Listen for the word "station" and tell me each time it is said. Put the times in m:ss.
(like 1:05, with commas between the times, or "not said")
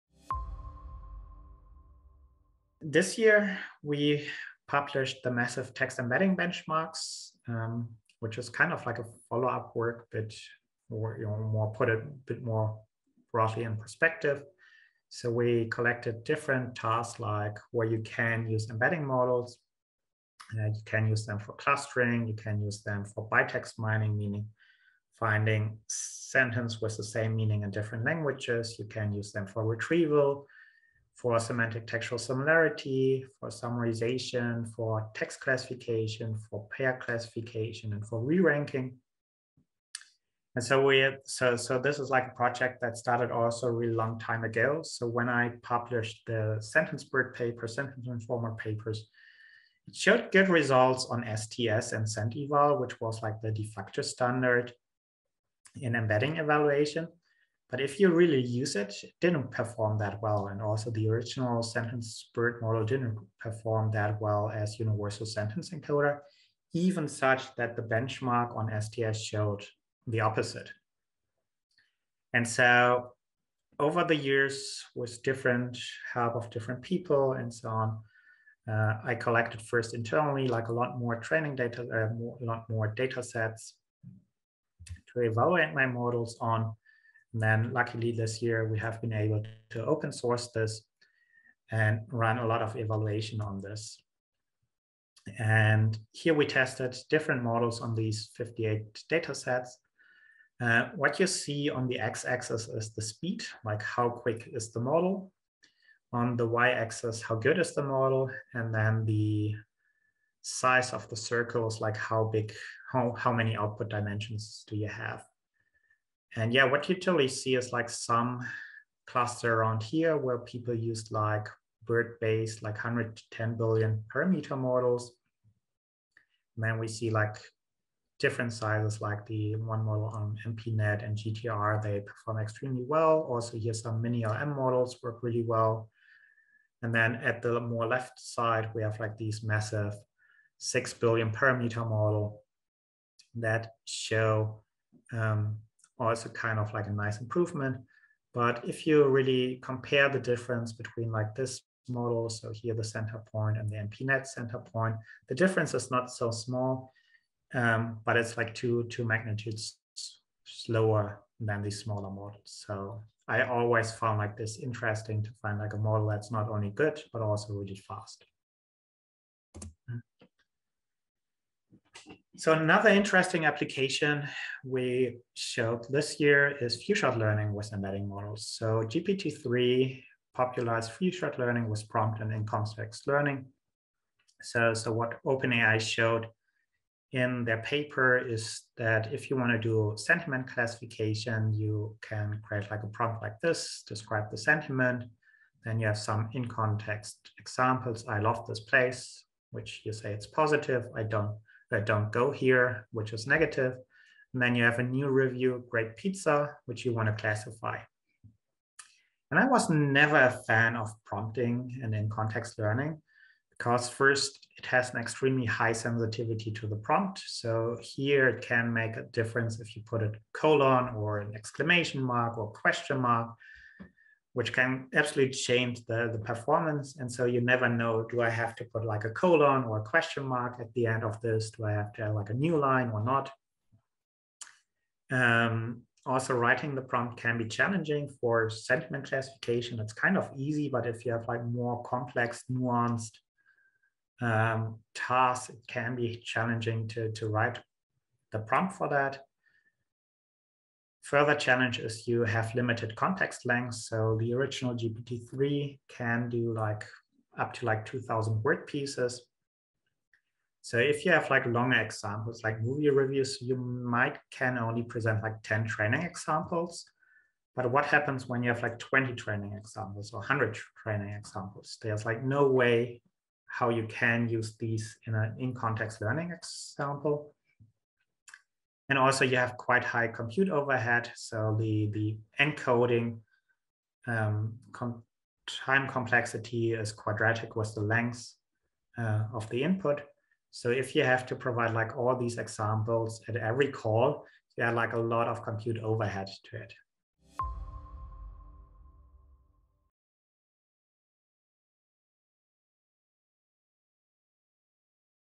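not said.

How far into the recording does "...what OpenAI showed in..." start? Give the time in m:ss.
3:04.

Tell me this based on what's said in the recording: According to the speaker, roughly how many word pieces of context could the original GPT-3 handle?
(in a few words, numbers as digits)
2000.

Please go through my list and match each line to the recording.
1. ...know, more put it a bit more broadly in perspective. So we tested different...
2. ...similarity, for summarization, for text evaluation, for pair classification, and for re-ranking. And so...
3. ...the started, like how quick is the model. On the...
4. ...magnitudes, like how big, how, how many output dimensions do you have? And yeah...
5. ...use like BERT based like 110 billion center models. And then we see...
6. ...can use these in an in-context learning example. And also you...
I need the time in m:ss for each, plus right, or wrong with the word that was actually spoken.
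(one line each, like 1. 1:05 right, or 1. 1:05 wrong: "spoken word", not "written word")
1. 0:11 wrong: "collected", not "tested"
2. 0:32 wrong: "classification", not "evaluation"
3. 1:42 wrong: "speed", not "started"
4. 1:51 wrong: "circles", not "magnitudes"
5. 2:00 wrong: "parameter", not "center"
6. 4:33 right.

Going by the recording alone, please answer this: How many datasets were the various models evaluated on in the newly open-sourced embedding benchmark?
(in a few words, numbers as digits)
58.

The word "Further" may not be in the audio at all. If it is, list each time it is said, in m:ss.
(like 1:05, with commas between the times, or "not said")
4:11.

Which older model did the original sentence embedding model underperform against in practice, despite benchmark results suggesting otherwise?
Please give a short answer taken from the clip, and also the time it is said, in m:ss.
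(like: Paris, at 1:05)
Universal Sentence Encoder, at 1:04.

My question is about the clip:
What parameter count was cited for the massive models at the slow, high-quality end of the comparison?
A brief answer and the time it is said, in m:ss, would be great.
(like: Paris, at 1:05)
6 billion, at 2:20.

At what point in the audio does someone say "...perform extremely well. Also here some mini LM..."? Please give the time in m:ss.
2:12.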